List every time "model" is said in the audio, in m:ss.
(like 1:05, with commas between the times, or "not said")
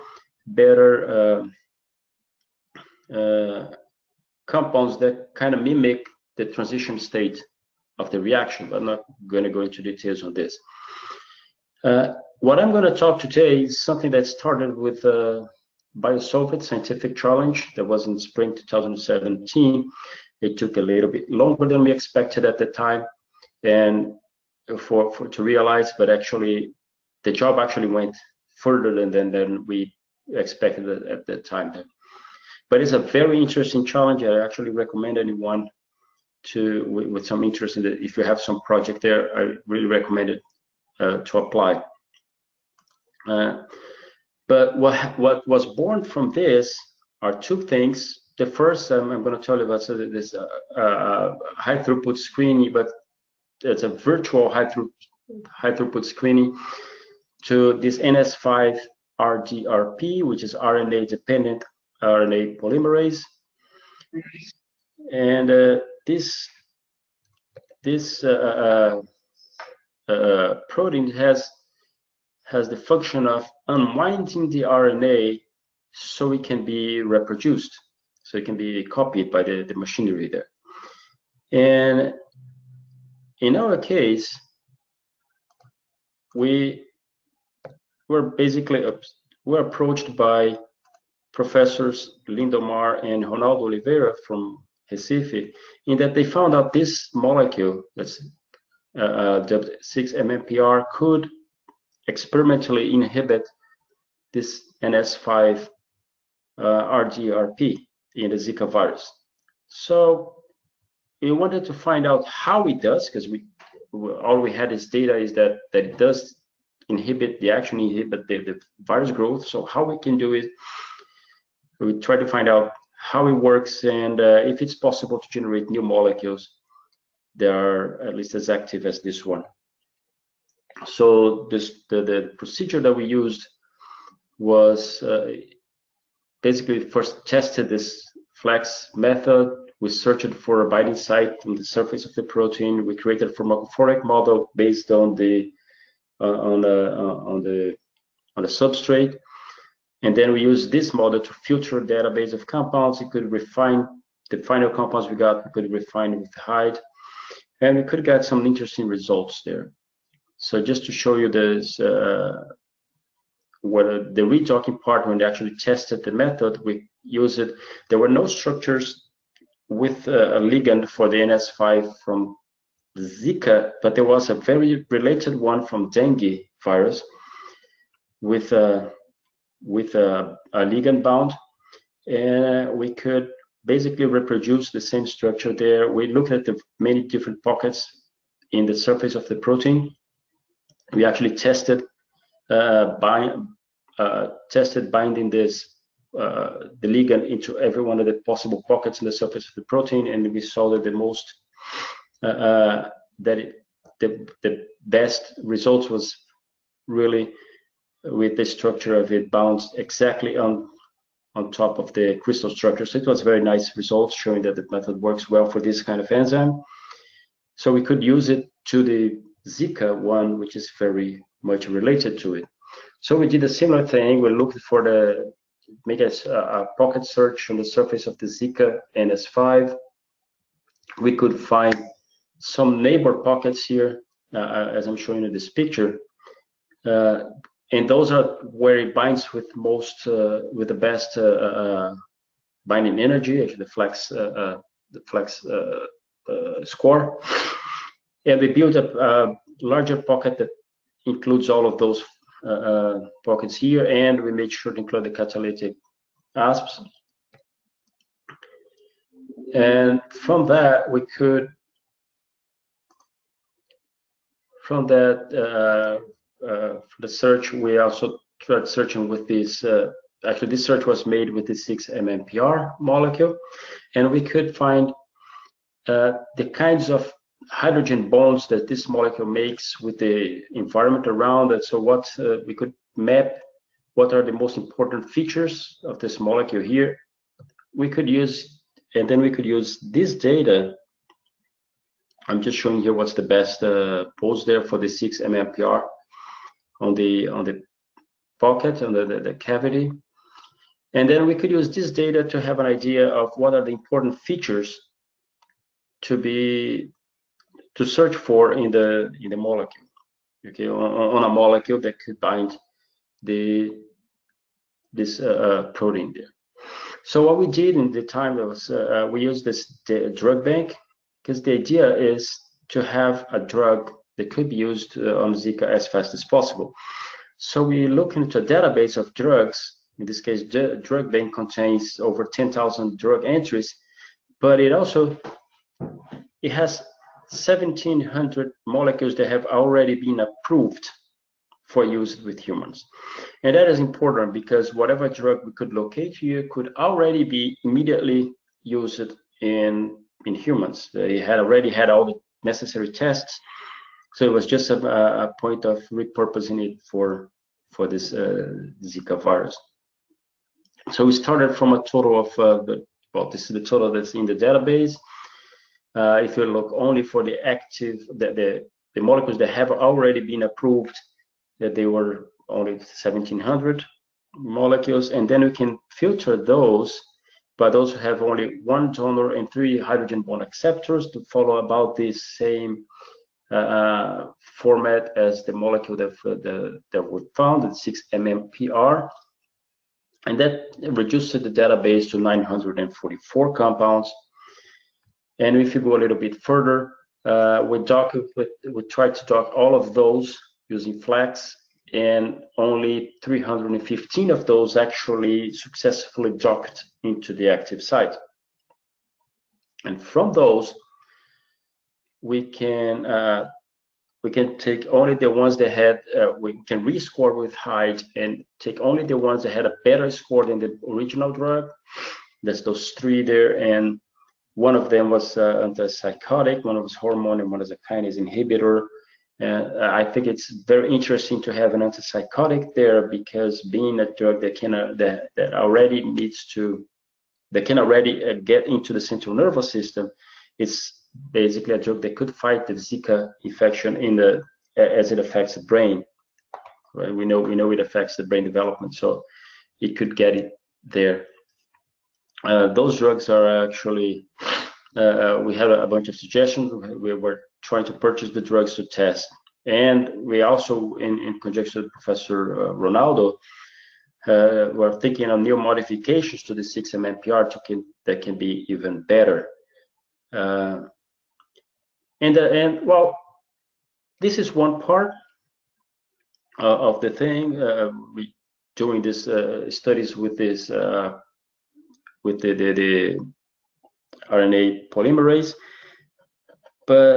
2:24, 2:30.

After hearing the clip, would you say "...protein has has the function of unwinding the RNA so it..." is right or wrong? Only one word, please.
right.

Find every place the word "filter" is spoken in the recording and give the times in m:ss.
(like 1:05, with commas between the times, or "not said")
2:31, 6:15.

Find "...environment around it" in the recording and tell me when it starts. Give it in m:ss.
4:40.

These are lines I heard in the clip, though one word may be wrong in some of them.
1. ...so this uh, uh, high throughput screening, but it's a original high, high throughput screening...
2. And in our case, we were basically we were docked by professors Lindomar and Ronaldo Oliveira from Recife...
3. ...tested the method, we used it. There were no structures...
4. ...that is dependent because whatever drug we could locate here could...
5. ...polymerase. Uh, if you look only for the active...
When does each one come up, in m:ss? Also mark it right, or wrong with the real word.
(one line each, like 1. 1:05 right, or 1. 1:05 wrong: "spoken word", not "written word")
1. 0:49 wrong: "virtual", not "original"
2. 1:21 wrong: "approached", not "docked"
3. 2:45 right
4. 5:43 wrong: "important", not "dependent"
5. 6:04 wrong: "database", not "polymerase".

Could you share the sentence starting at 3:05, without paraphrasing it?
We looked at the many different pockets in the surface of the protein.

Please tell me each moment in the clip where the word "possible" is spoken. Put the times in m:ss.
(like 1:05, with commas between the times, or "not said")
2:04, 3:18, 5:26.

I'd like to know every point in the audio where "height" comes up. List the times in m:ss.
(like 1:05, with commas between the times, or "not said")
2:36, 6:57.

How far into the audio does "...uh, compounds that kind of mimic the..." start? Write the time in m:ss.
0:03.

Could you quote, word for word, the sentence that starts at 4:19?
And from that, we could from that uh, for uh, the search, we also tried searching with this.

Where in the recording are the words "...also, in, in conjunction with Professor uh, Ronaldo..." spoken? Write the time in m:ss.
7:40.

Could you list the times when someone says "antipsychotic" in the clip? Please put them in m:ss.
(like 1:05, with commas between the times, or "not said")
7:05, 7:11.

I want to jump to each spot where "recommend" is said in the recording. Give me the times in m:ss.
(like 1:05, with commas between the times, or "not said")
0:34, 0:39.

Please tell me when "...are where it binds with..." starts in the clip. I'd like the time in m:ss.
3:58.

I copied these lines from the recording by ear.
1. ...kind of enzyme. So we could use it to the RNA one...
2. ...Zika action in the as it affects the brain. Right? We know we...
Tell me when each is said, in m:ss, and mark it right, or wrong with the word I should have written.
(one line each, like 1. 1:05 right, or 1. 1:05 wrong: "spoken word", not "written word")
1. 3:35 wrong: "Zika", not "RNA"
2. 7:22 wrong: "infection", not "action".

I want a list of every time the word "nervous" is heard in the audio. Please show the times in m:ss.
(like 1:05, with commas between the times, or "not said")
7:19.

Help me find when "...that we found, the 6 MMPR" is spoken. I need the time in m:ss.
6:26.